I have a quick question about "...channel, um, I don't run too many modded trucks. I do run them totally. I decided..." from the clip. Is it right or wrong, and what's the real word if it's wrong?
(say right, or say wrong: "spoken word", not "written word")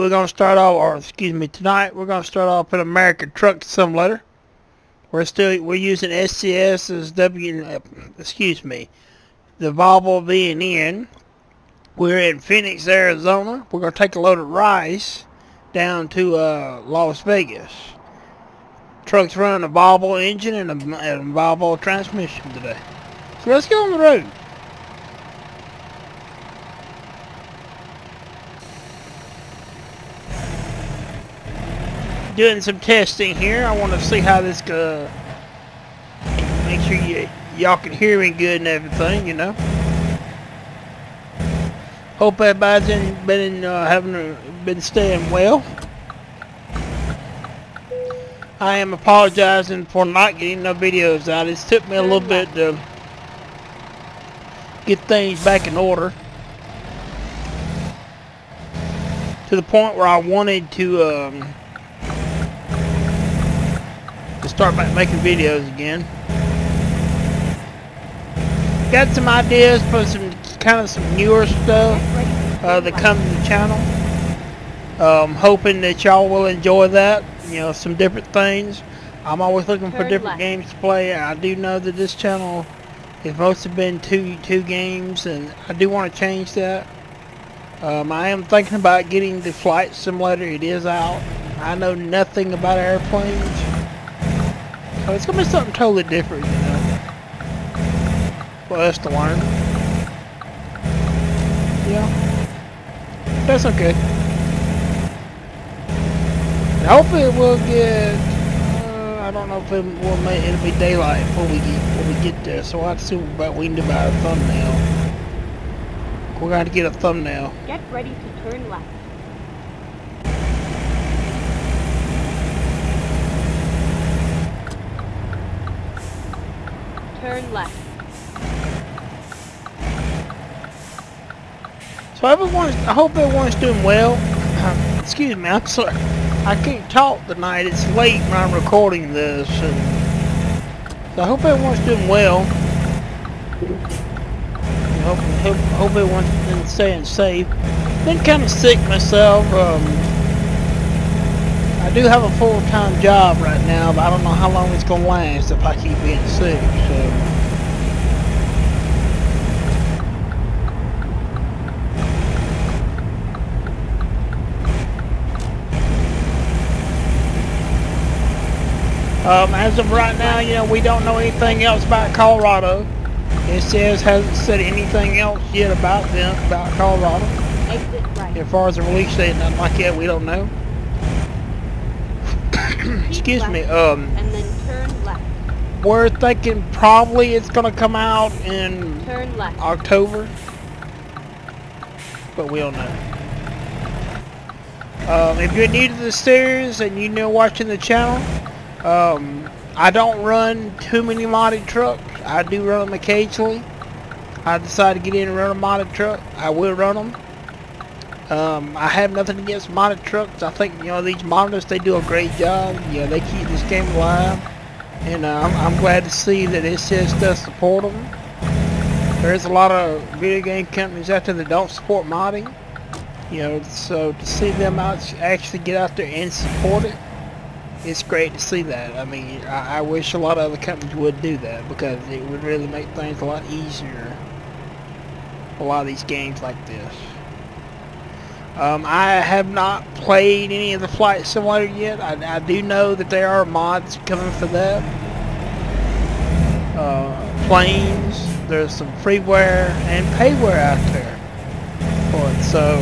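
wrong: "occasionally", not "totally".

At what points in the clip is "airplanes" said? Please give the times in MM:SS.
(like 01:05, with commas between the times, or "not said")
01:32.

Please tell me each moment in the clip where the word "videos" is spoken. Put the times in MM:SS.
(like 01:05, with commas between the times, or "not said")
00:50, 01:05, 03:40.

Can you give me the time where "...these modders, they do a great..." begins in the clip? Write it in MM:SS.
03:31.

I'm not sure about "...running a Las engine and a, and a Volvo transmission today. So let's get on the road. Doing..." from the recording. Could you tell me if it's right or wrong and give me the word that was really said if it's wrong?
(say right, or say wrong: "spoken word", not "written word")
wrong: "Volvo", not "Las".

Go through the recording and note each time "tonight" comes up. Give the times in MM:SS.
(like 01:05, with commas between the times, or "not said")
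00:01, 02:17.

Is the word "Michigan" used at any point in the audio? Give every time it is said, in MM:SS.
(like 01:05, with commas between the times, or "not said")
not said.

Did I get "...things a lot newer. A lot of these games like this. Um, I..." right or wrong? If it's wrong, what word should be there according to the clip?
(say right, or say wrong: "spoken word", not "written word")
wrong: "easier", not "newer".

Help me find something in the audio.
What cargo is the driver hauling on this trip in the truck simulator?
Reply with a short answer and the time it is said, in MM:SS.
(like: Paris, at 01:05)
Rice, at 00:14.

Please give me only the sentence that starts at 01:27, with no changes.
Um, I am thinking about getting the flight simulator.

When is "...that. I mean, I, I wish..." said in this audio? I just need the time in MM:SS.
03:48.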